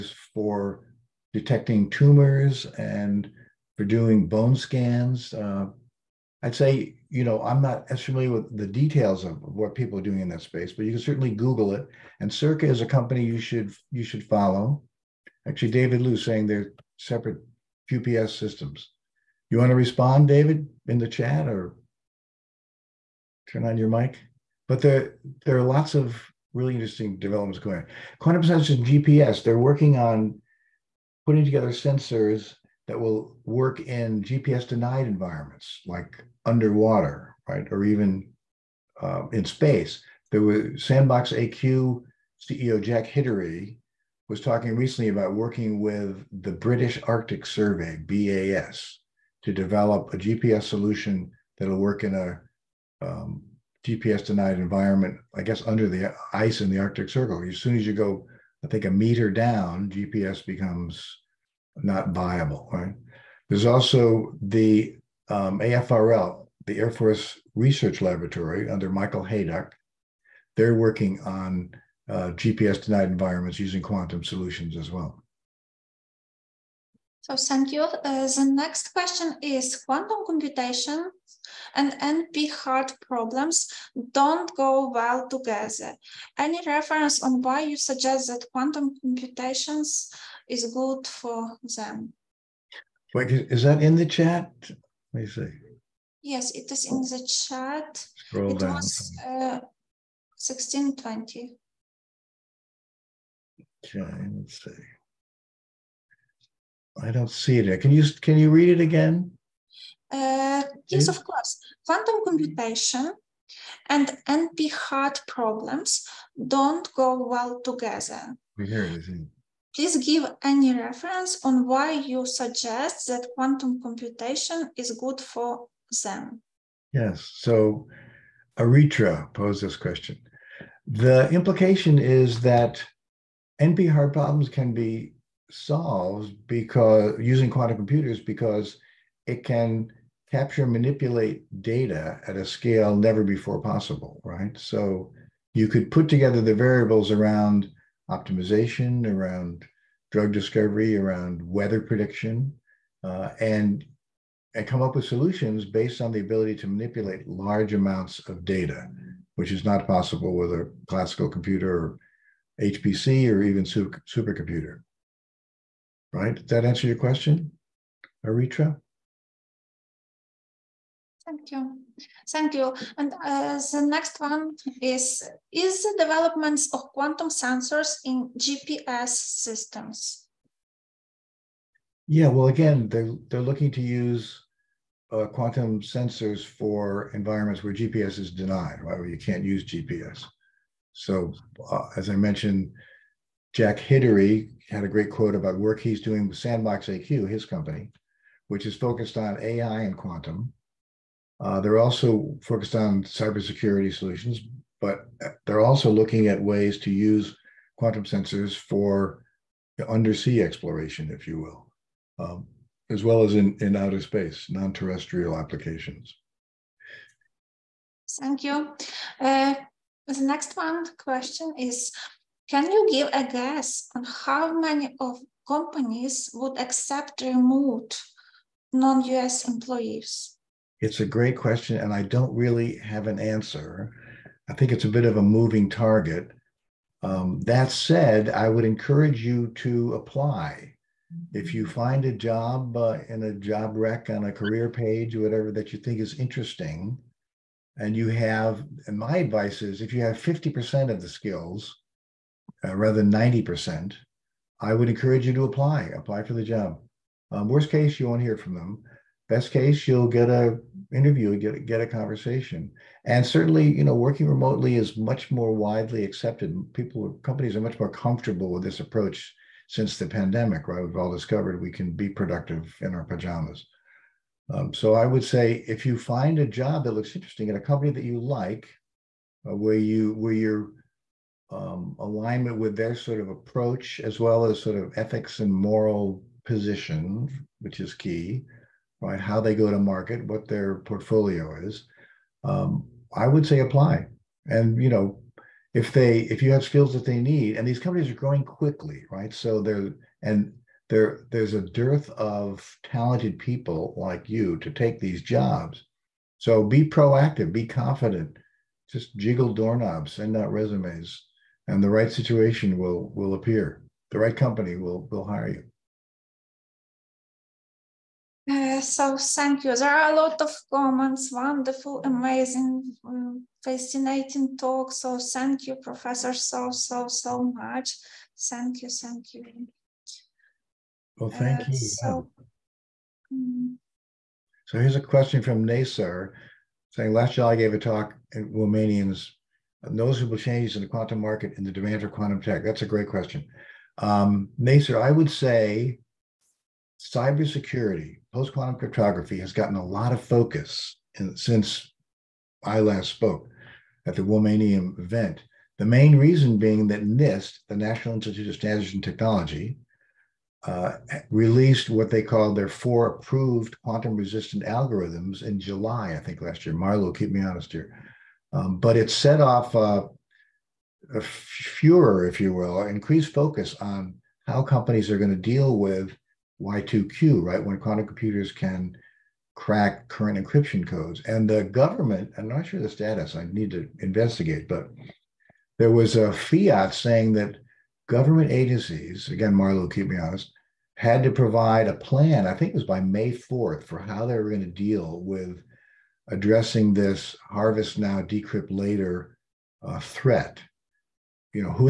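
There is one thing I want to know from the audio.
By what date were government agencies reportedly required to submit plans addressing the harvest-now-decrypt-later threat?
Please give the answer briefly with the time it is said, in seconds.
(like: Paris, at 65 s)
May 4th, at 393 s.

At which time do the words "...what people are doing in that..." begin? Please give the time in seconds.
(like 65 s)
9 s.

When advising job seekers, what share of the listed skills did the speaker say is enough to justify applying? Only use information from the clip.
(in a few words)
50%.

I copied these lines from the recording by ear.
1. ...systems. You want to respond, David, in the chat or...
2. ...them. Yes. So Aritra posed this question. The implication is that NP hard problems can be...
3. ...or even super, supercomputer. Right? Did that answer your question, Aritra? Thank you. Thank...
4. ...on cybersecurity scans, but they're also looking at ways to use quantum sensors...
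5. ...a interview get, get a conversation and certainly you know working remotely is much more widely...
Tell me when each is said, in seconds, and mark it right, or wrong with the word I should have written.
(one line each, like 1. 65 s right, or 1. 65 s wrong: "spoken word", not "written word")
1. 18 s right
2. 126 s right
3. 163 s right
4. 202 s wrong: "solutions", not "scans"
5. 260 s right.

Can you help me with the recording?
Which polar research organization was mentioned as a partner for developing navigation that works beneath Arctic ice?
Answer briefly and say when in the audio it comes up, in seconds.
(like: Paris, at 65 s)
British Arctic Survey, at 46 s.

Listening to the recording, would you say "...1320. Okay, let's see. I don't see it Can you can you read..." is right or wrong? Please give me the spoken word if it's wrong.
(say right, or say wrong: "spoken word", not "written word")
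wrong: "1620", not "1320".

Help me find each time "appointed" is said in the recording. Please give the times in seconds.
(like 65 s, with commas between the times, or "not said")
not said.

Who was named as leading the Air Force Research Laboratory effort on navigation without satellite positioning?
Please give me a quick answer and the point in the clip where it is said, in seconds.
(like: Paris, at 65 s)
Michael Hayduk, at 68 s.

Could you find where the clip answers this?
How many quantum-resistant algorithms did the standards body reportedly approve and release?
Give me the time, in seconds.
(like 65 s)
362 s.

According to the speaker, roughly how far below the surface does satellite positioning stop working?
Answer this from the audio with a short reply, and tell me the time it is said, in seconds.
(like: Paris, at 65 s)
a meter, at 58 s.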